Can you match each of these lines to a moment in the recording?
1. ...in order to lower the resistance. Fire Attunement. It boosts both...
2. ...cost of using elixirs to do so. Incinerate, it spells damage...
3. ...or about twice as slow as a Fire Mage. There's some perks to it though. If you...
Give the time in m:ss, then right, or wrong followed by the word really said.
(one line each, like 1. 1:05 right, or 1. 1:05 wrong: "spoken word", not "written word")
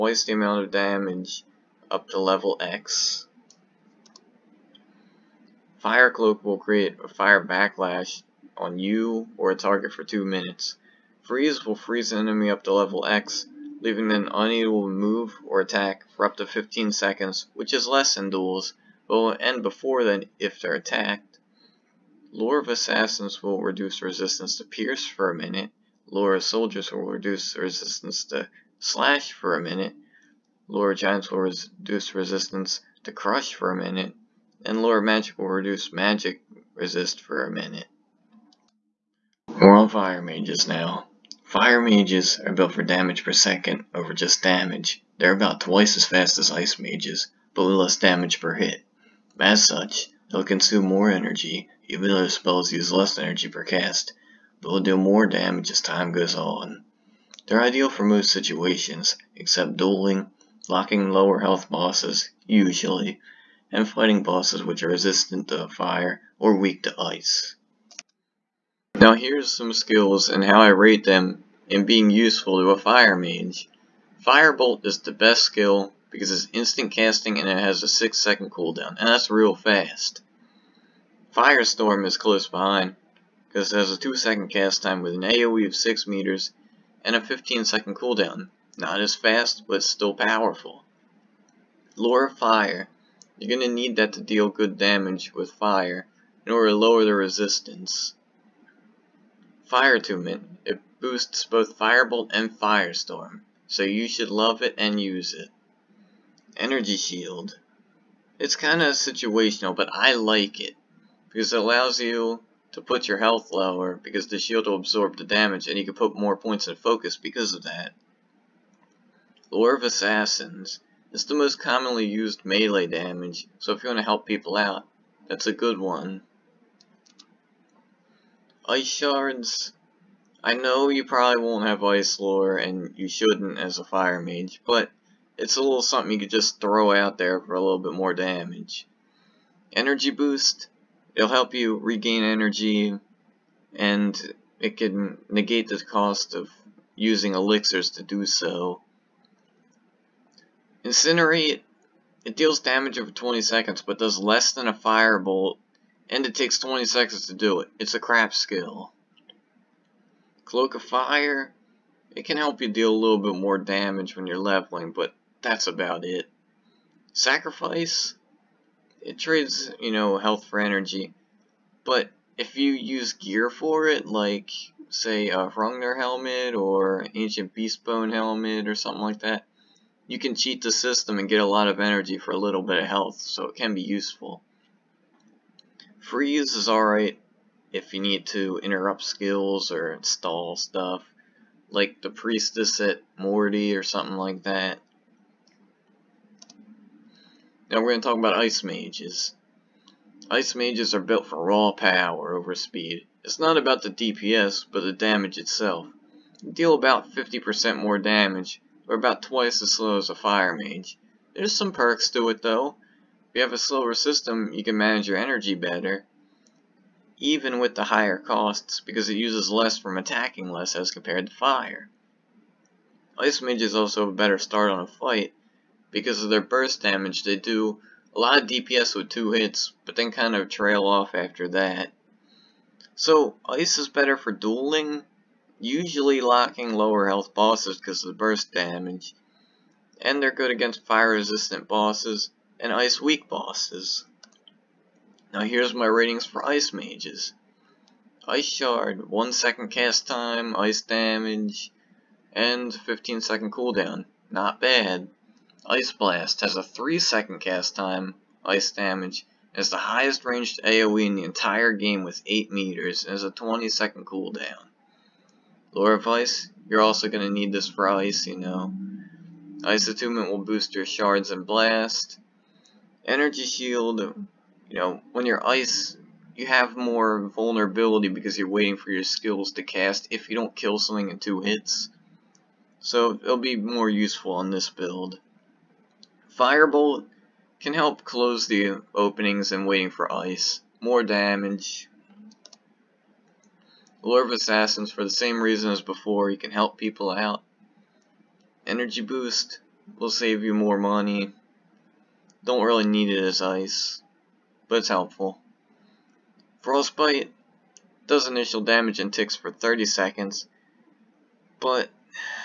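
1. 1:36 right
2. 2:25 wrong: "deals", not "spells"
3. 3:28 right.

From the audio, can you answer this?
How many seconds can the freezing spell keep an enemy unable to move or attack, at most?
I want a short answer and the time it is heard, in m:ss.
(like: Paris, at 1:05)
15, at 0:16.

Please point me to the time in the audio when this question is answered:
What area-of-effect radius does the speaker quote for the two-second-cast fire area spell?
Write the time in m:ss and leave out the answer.
1:25.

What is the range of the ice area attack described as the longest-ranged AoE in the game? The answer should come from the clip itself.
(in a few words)
8 meters.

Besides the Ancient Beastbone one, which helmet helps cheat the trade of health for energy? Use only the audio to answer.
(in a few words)
Hrungnir helmet.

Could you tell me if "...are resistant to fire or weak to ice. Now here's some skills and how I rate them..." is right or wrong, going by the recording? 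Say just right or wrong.
right.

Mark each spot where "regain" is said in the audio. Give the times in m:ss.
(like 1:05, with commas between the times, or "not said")
2:21.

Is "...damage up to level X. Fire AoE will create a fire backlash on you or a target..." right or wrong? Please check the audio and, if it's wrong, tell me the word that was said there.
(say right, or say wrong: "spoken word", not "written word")
wrong: "Cloak", not "AoE".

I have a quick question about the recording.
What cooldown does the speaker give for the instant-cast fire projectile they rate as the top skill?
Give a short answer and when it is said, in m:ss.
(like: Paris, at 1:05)
6 seconds, at 1:17.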